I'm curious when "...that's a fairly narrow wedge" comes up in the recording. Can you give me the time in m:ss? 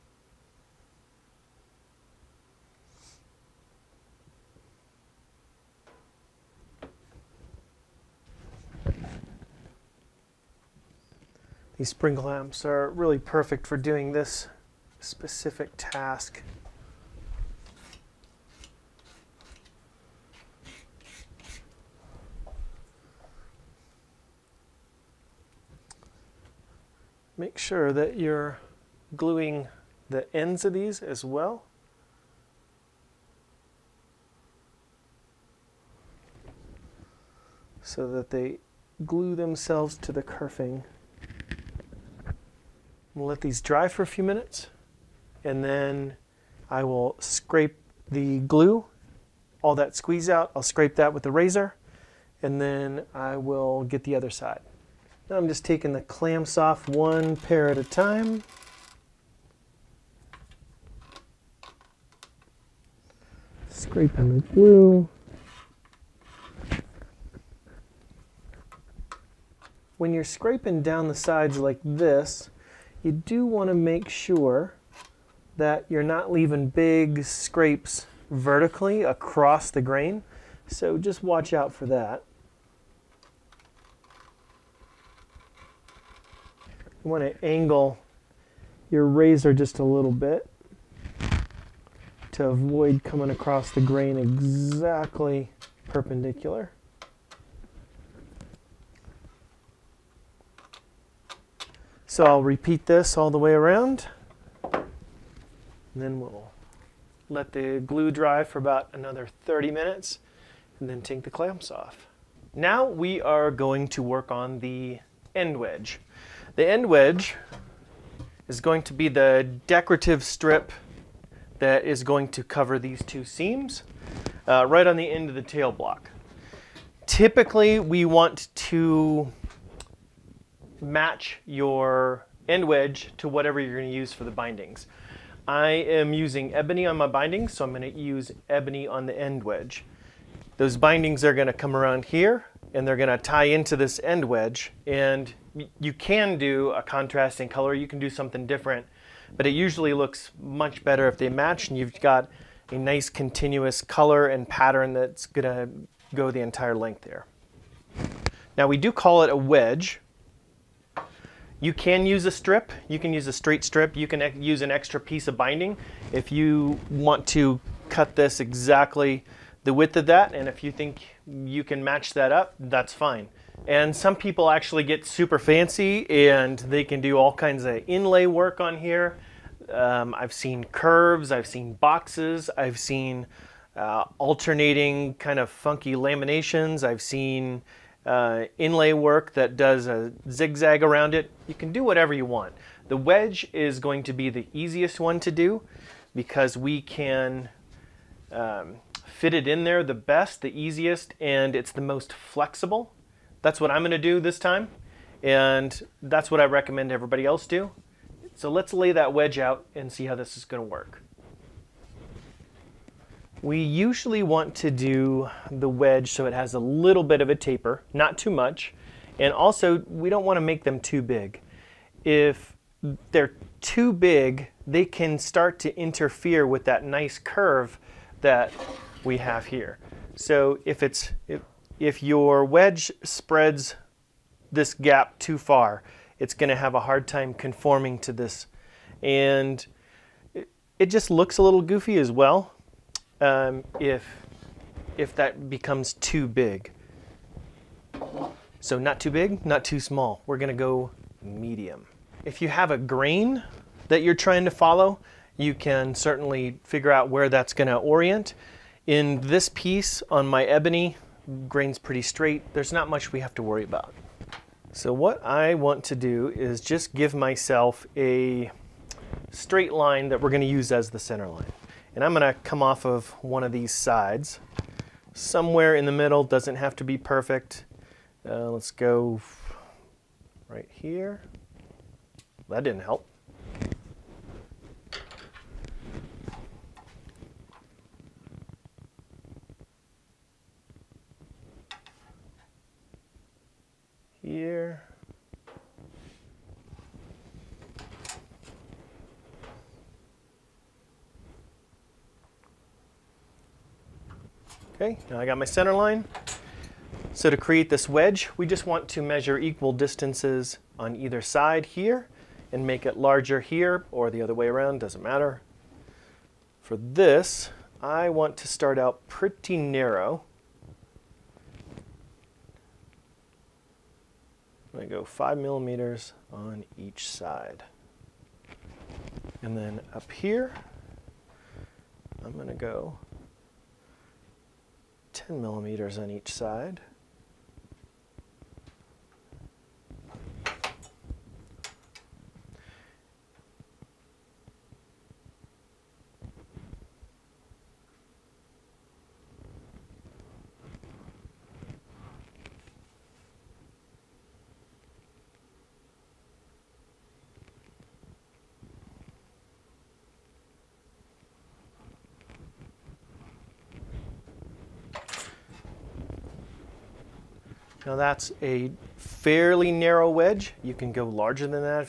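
6:07.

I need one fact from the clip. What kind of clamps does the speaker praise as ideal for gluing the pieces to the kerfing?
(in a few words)
Spring clamps.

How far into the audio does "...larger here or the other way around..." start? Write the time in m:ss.
5:12.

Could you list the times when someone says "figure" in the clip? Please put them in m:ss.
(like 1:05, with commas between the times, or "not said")
4:16.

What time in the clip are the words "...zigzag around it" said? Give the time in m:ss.
3:10.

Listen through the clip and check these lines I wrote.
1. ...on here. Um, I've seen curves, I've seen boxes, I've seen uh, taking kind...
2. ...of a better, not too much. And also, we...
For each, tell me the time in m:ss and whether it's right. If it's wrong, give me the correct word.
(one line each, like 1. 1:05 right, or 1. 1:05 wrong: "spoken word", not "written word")
1. 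2:58 wrong: "alternating", not "taking"
2. 3:37 wrong: "taper", not "better".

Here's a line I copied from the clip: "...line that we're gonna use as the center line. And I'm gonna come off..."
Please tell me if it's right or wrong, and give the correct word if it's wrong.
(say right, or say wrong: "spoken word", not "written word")
right.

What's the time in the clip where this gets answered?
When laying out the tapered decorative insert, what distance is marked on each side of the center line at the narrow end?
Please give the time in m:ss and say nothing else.
5:25.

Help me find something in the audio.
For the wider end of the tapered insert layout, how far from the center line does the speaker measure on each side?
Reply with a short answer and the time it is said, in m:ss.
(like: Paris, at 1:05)
10 millimeters, at 5:35.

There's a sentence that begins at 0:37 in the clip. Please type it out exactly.
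so that they glue themselves to the kerfing.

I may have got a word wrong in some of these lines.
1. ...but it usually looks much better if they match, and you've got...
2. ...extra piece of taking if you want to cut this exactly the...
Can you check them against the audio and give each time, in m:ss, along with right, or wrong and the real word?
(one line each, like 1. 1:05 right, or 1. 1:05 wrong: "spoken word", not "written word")
1. 2:29 right
2. 2:44 wrong: "binding", not "taking".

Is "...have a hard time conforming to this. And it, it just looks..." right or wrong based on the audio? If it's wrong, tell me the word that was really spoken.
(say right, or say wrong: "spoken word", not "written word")
right.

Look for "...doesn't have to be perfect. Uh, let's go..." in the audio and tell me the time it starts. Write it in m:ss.
4:36.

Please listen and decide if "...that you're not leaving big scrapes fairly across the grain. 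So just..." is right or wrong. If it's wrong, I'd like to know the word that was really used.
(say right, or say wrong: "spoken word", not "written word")
wrong: "vertically", not "fairly".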